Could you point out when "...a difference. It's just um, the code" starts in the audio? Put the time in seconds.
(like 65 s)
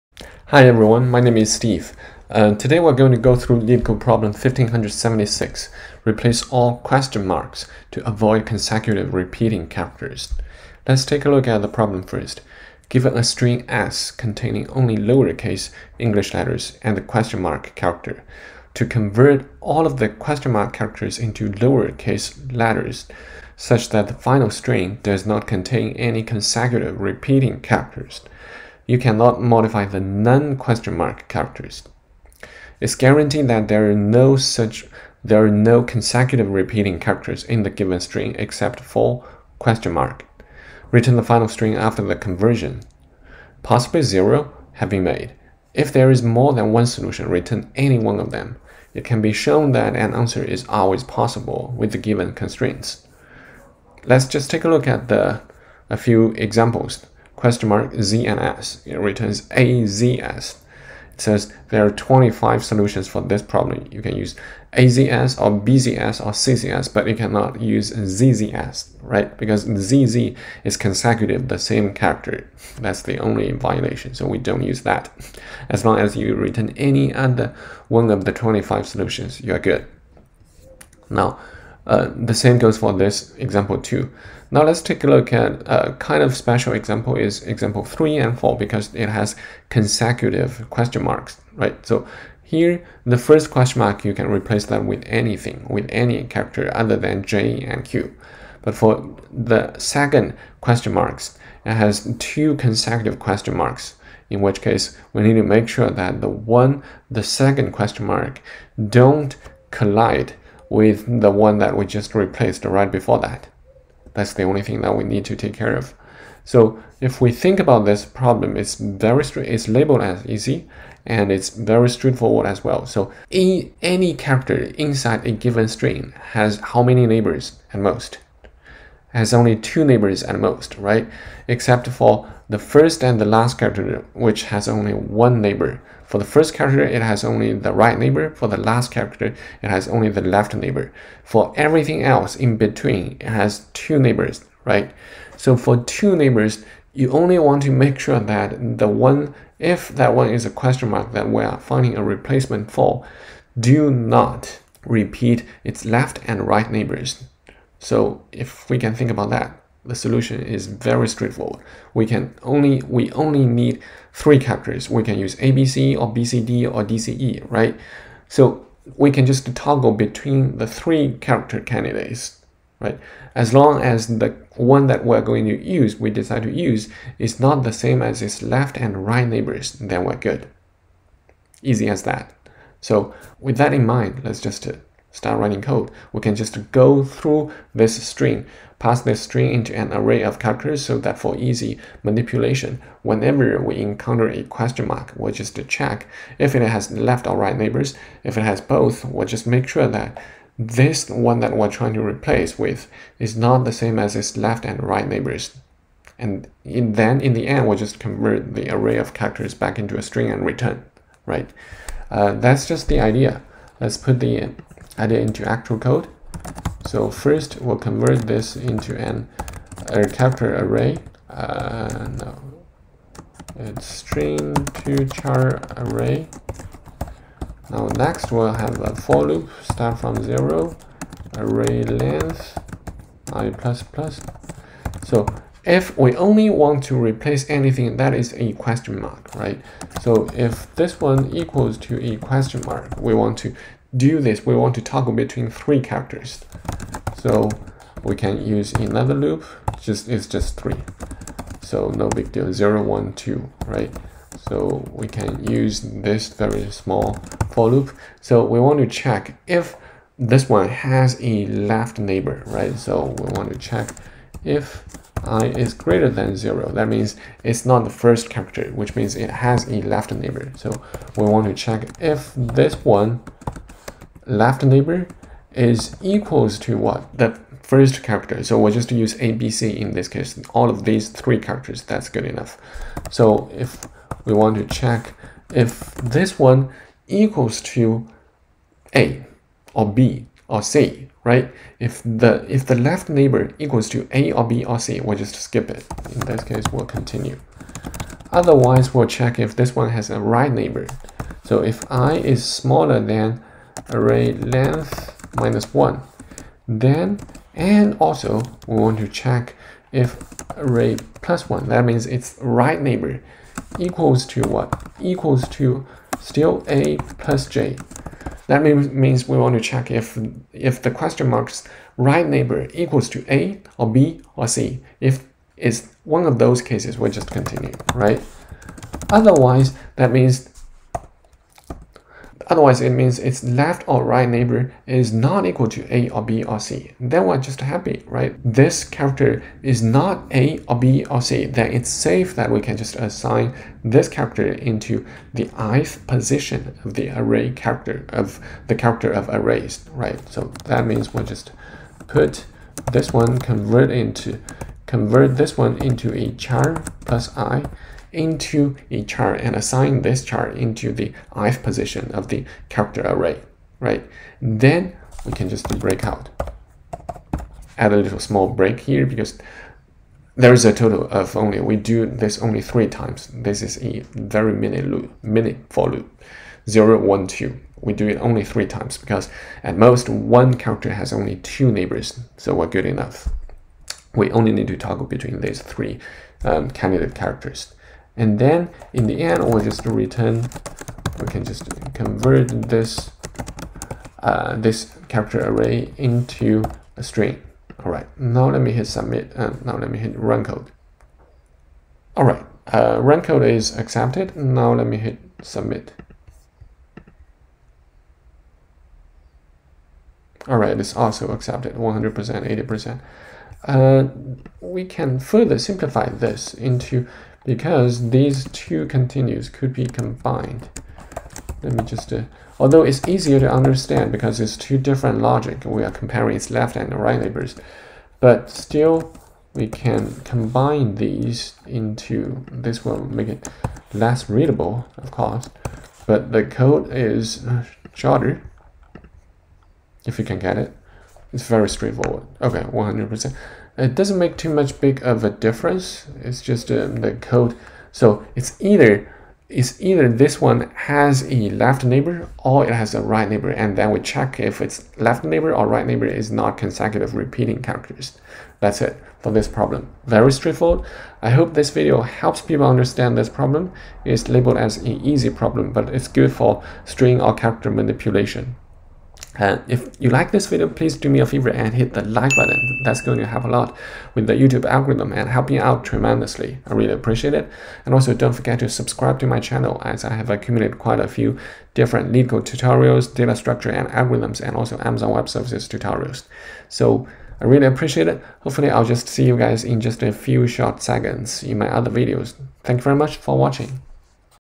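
445 s.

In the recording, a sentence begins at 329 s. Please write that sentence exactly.
Otherwise, that means Otherwise, it means its left or right neighbor is not equal to A or B or C.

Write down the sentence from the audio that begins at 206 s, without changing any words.
And in, then in the end, we'll just convert the array of characters back into a string and return, right?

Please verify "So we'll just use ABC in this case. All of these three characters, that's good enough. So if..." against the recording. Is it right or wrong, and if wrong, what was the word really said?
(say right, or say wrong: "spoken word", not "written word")
right.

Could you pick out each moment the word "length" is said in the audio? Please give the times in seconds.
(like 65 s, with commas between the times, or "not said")
231 s, 304 s.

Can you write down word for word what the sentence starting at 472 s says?
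That's going to help a lot with the YouTube algorithm and helping out tremendously.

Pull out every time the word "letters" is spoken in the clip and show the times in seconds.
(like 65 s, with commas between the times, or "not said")
16 s, 22 s.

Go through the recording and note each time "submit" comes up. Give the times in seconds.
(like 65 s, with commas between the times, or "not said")
398 s, 405 s.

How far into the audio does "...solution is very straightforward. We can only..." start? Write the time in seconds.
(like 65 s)
159 s.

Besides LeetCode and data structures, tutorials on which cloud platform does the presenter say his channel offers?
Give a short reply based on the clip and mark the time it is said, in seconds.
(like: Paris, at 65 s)
Amazon Web Services, at 484 s.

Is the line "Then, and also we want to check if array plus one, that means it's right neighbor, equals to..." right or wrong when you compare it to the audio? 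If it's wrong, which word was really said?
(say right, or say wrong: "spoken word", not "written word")
right.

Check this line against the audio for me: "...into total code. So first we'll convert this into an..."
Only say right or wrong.
wrong.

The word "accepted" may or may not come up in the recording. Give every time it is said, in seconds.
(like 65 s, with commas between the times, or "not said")
403 s, 411 s.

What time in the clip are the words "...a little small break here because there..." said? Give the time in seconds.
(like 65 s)
367 s.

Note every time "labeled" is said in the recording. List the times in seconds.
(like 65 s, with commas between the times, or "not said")
119 s, 464 s.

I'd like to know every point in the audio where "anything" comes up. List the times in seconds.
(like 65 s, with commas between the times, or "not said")
95 s, 237 s.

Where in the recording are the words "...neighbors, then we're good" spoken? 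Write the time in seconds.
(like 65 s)
179 s.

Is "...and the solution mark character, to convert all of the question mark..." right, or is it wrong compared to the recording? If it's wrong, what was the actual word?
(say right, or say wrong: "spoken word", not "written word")
wrong: "question", not "solution".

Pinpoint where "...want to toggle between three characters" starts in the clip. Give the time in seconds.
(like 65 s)
244 s.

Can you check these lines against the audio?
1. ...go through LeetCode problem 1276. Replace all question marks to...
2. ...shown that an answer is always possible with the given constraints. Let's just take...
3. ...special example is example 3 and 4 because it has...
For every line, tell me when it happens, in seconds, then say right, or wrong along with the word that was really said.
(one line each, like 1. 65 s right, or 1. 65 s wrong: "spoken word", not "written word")
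1. 3 s wrong: "1576", not "1276"
2. 49 s right
3. 86 s right.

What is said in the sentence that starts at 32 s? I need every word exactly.
It's guaranteed that there are no such there are no consecutive repeating characters in the given string except for question mark.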